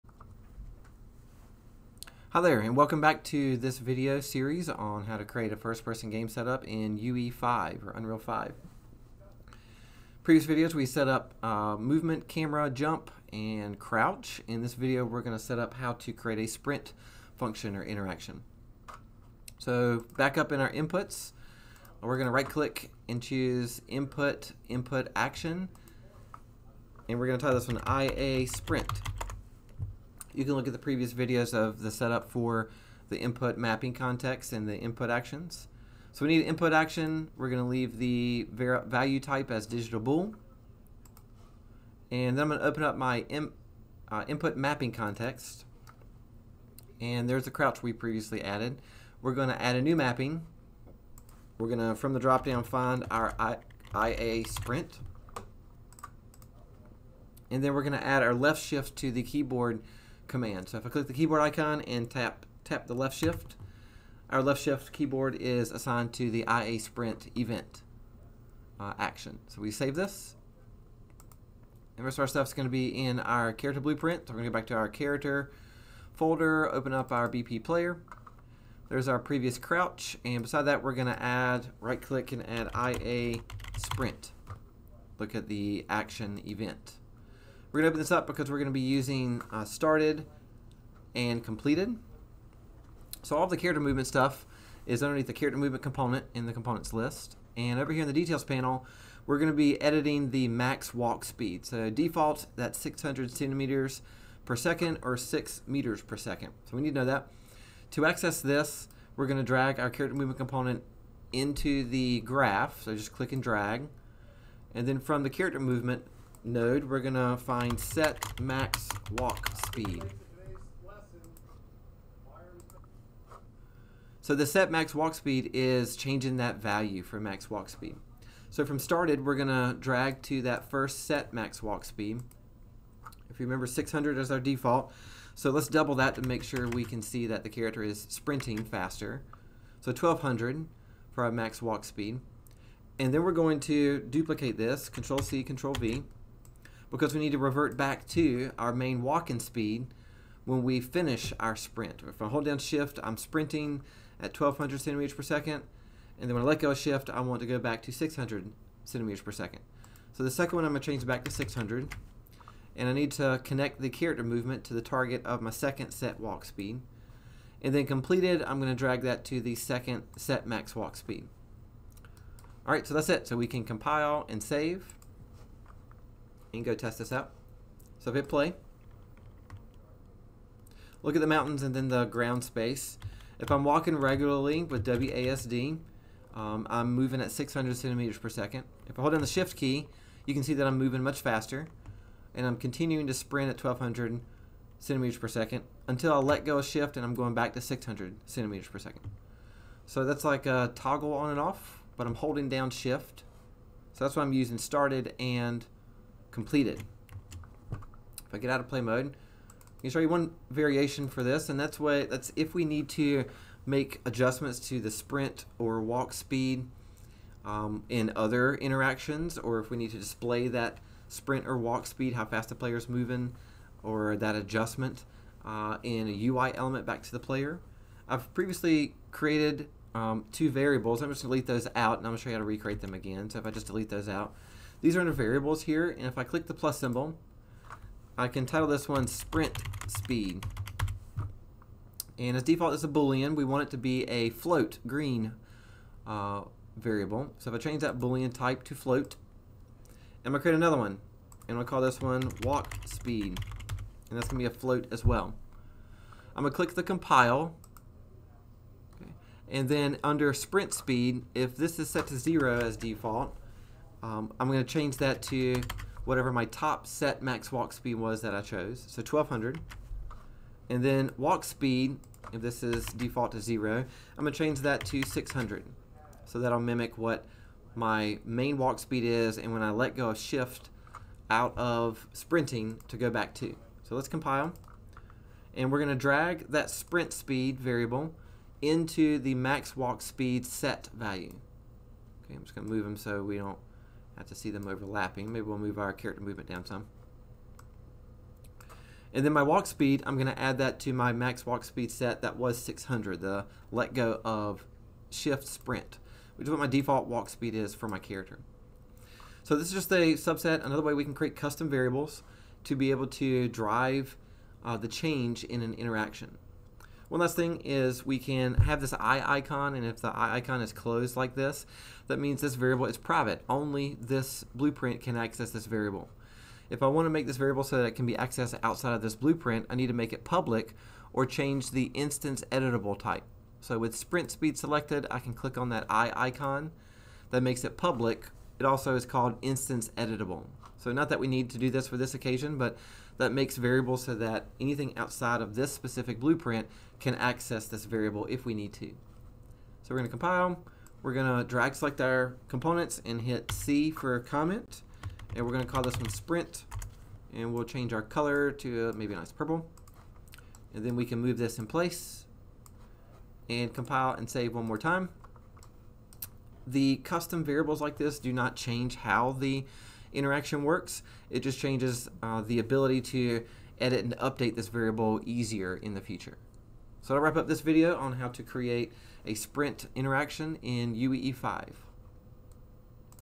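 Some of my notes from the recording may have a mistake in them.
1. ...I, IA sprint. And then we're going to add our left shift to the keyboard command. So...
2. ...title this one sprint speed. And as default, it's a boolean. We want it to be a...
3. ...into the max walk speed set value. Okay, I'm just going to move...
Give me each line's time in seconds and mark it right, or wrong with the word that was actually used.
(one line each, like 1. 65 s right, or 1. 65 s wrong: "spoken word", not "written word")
1. 53 s right
2. 238 s right
3. 288 s right.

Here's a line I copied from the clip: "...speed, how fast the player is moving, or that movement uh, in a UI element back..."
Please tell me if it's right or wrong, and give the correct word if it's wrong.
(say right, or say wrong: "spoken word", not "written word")
wrong: "adjustment", not "movement".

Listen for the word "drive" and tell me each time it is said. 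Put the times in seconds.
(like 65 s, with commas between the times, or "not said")
313 s.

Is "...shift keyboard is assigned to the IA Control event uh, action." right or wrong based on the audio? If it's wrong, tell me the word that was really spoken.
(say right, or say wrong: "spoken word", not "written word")
wrong: "Sprint", not "Control".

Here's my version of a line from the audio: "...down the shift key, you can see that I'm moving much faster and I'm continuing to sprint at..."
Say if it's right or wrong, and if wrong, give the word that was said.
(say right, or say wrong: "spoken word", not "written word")
right.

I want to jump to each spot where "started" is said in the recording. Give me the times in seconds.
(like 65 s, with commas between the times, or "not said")
89 s, 128 s, 204 s.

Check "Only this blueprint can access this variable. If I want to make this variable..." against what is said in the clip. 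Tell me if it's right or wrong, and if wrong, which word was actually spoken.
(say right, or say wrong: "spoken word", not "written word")
right.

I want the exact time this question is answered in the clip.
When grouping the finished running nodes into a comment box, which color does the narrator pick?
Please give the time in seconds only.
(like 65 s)
359 s.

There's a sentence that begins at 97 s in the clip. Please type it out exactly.
And over here in the details panel, we're going to be editing the max walk speed.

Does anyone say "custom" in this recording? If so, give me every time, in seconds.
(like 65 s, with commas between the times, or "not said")
311 s, 366 s.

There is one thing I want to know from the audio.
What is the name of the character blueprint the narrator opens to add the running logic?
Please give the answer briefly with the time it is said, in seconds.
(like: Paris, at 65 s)
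BP player, at 77 s.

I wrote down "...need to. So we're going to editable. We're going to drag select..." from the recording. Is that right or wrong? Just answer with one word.
wrong.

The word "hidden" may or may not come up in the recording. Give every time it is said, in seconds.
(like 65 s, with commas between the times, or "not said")
not said.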